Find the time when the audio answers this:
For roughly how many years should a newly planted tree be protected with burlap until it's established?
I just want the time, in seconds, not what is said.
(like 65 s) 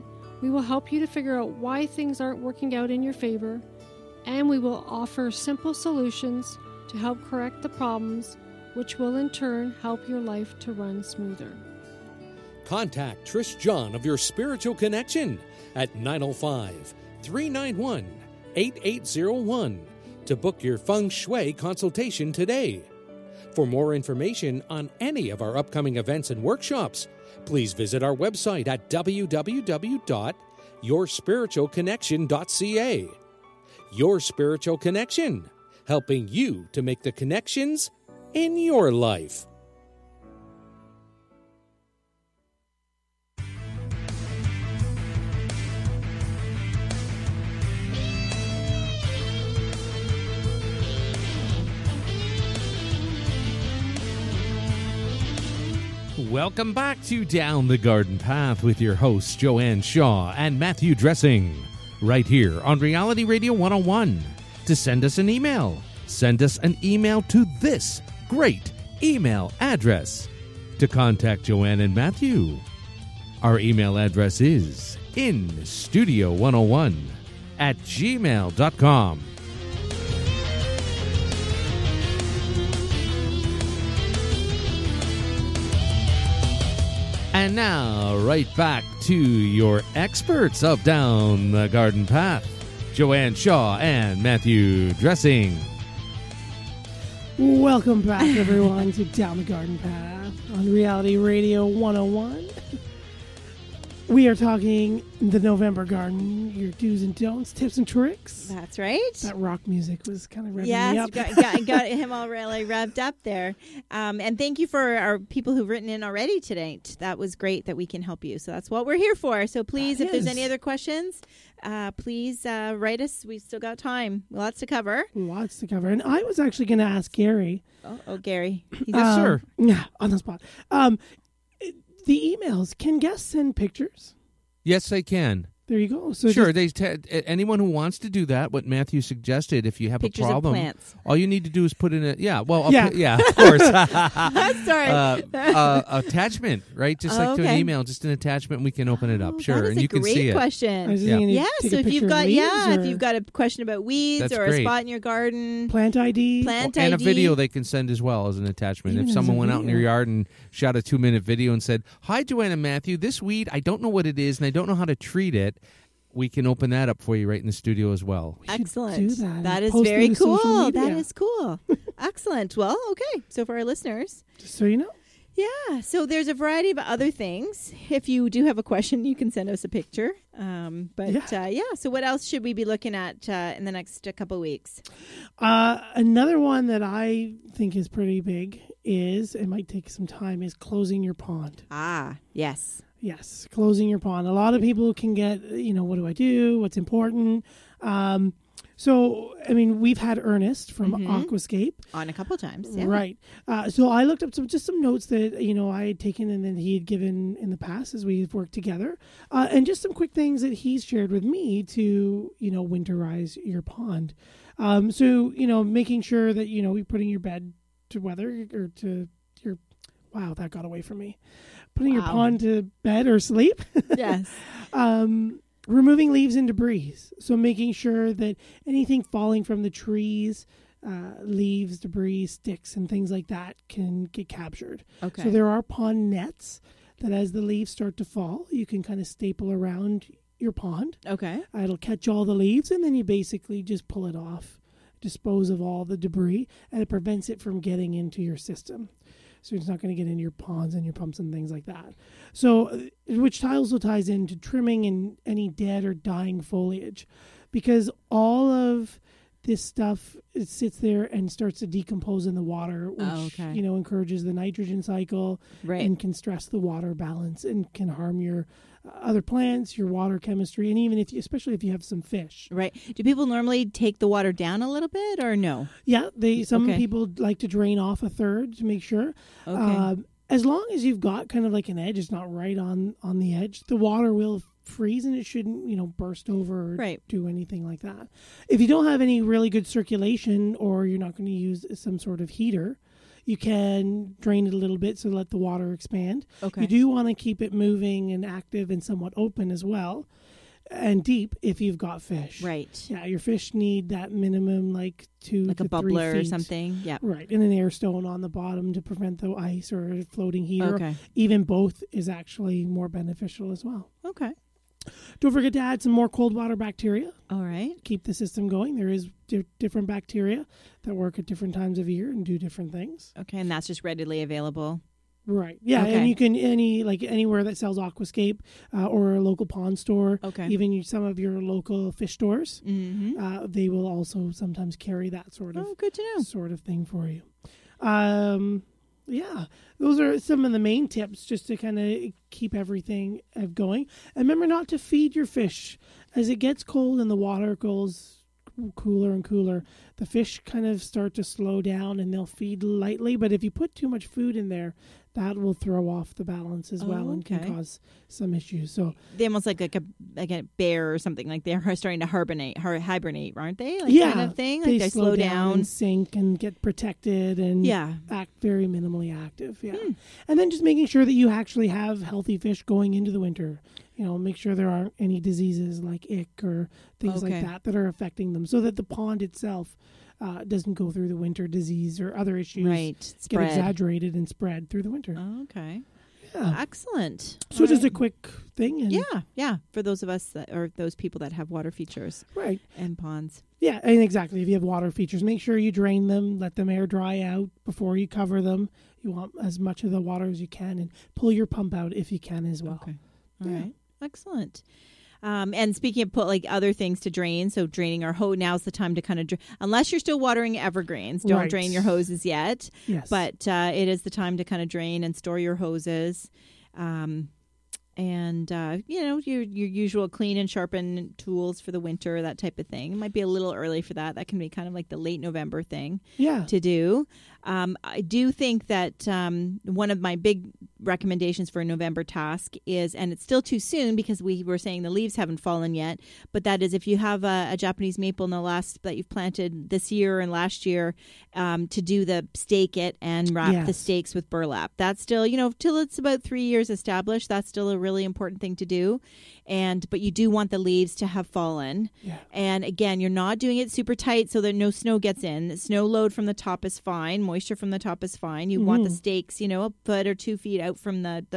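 446 s.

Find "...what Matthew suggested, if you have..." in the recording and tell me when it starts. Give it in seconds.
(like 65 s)
138 s.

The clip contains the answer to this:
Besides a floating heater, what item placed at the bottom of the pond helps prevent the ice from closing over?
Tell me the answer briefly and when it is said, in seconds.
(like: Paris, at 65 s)
air stone, at 307 s.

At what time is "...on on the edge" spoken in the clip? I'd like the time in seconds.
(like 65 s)
282 s.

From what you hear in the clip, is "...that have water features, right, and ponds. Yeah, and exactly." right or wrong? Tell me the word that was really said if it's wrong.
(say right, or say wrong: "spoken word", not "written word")
right.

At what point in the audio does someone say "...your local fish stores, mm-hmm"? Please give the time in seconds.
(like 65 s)
331 s.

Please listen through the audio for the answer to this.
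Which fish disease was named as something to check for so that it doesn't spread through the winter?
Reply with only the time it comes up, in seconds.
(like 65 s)
376 s.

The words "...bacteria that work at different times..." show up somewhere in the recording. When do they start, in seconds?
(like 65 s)
319 s.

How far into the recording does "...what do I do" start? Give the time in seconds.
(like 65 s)
195 s.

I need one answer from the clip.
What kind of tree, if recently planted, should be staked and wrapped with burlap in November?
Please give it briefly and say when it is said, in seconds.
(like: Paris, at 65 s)
Japanese maple, at 437 s.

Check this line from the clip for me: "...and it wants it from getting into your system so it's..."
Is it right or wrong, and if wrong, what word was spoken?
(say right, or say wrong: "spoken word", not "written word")
wrong: "prevents", not "wants".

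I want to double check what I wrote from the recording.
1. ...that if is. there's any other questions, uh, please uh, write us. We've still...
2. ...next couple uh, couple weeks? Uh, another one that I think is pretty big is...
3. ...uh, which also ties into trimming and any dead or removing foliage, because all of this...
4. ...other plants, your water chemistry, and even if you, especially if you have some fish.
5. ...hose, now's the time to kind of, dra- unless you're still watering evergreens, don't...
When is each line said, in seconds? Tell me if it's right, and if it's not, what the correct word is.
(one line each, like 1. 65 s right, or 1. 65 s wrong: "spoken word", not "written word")
1. 119 s right
2. 183 s right
3. 252 s wrong: "dying", not "removing"
4. 269 s right
5. 408 s right.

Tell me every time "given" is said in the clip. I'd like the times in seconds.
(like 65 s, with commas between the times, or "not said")
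206 s.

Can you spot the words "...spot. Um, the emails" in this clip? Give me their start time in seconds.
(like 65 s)
130 s.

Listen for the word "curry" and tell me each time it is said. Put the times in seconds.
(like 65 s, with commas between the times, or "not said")
not said.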